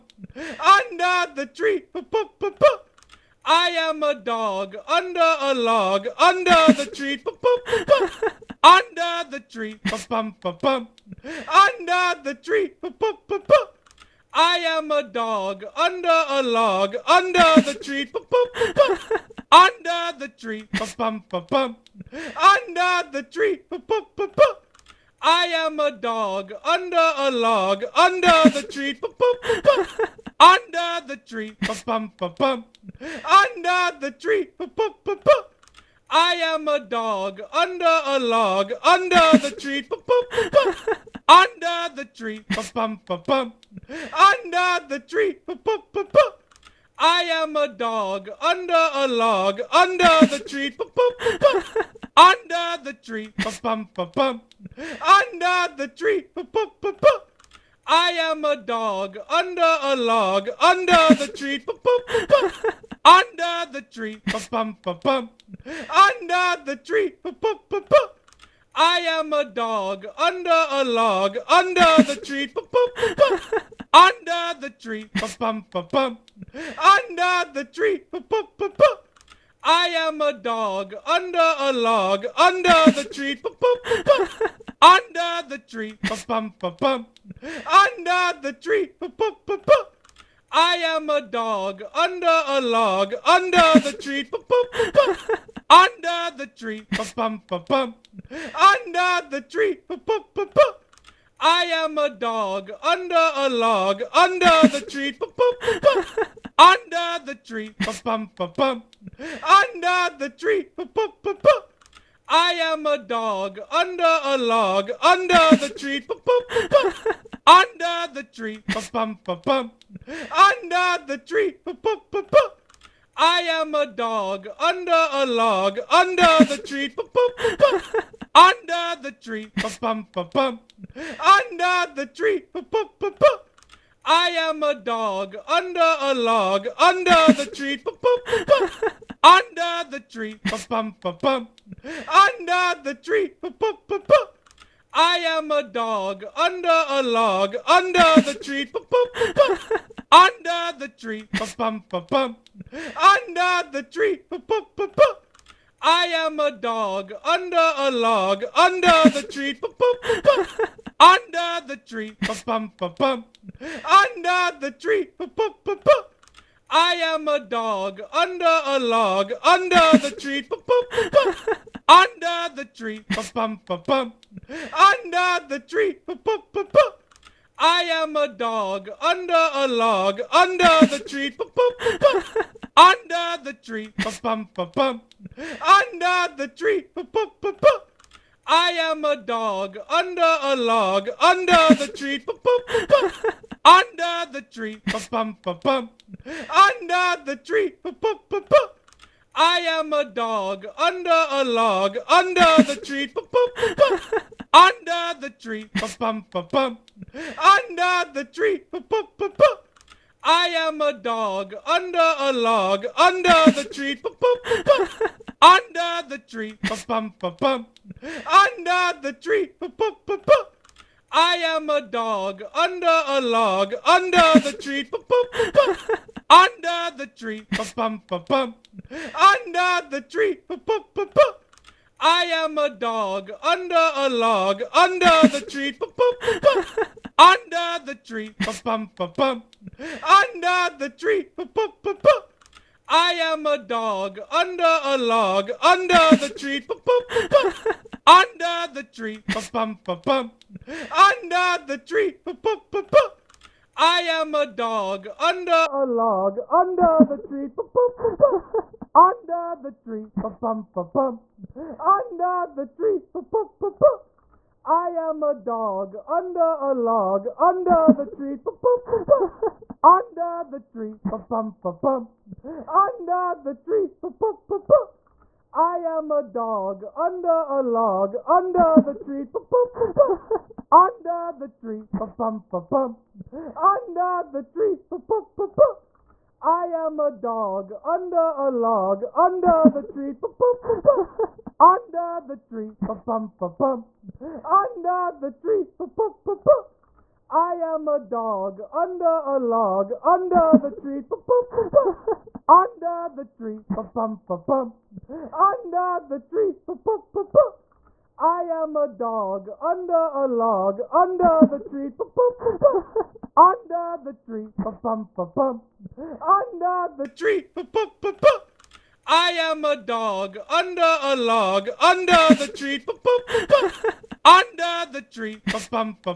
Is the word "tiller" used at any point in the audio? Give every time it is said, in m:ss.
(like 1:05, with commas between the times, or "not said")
not said.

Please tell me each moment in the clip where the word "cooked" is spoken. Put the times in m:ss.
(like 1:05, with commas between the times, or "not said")
not said.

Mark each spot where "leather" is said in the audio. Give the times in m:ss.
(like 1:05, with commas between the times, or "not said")
not said.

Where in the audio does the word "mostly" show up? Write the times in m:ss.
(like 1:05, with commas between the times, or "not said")
not said.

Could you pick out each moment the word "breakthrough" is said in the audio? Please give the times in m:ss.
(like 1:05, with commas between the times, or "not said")
not said.